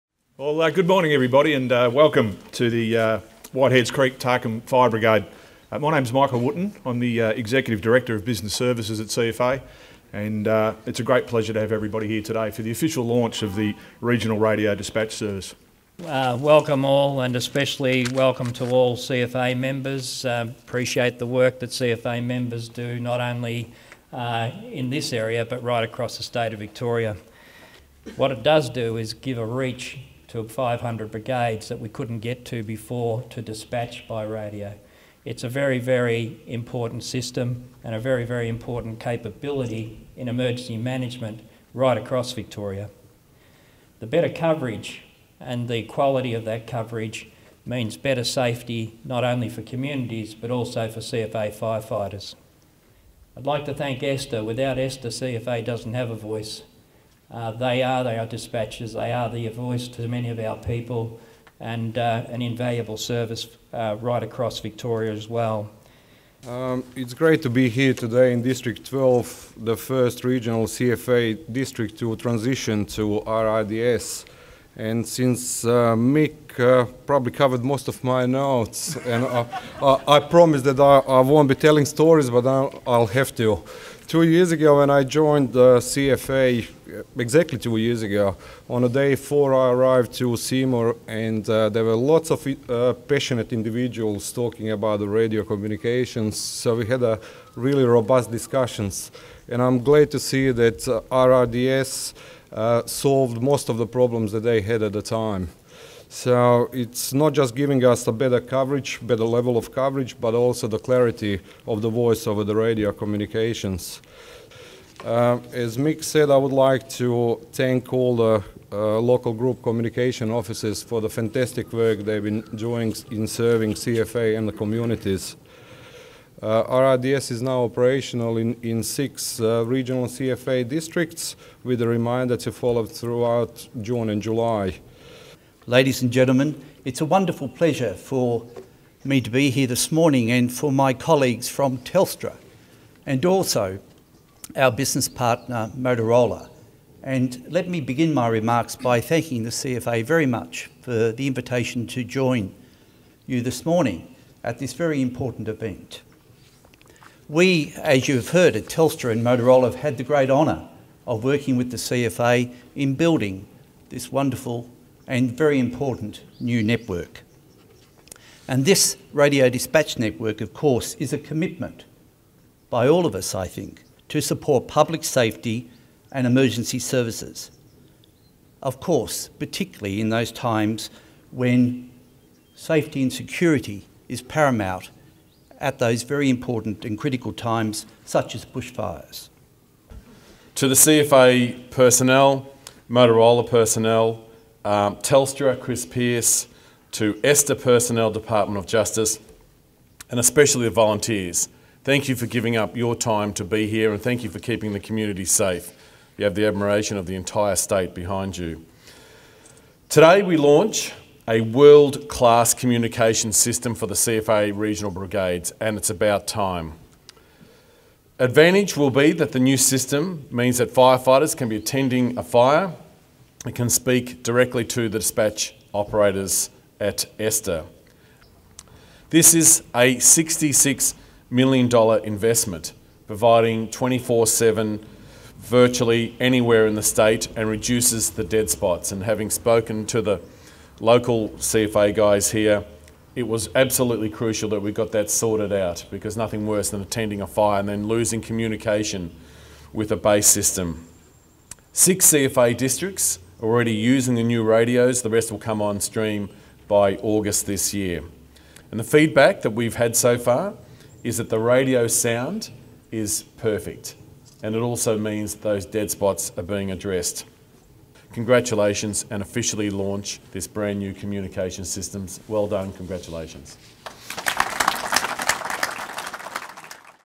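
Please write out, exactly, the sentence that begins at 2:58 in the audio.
Of course, particularly in those times when safety and security is paramount at those very important and critical times, such as bushfires.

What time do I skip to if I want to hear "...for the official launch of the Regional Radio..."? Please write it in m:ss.
0:12.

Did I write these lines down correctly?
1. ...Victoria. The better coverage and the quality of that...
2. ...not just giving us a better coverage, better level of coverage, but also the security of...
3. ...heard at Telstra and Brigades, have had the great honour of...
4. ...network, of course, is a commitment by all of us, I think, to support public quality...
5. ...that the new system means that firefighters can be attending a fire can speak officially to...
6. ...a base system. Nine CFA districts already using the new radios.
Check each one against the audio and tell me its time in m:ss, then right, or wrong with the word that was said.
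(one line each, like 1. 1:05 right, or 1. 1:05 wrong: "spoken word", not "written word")
1. 0:42 right
2. 1:47 wrong: "clarity", not "security"
3. 2:38 wrong: "Motorola", not "Brigades"
4. 2:49 wrong: "safety", not "quality"
5. 3:39 wrong: "directly", not "officially"
6. 4:09 wrong: "Six", not "Nine".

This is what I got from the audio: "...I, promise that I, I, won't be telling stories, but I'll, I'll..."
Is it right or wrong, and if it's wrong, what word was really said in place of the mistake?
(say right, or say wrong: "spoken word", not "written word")
right.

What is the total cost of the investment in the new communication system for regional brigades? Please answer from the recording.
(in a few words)
$66 million.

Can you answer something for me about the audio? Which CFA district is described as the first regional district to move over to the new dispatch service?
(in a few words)
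District 12.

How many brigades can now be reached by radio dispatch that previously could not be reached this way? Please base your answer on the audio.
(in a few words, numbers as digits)
500.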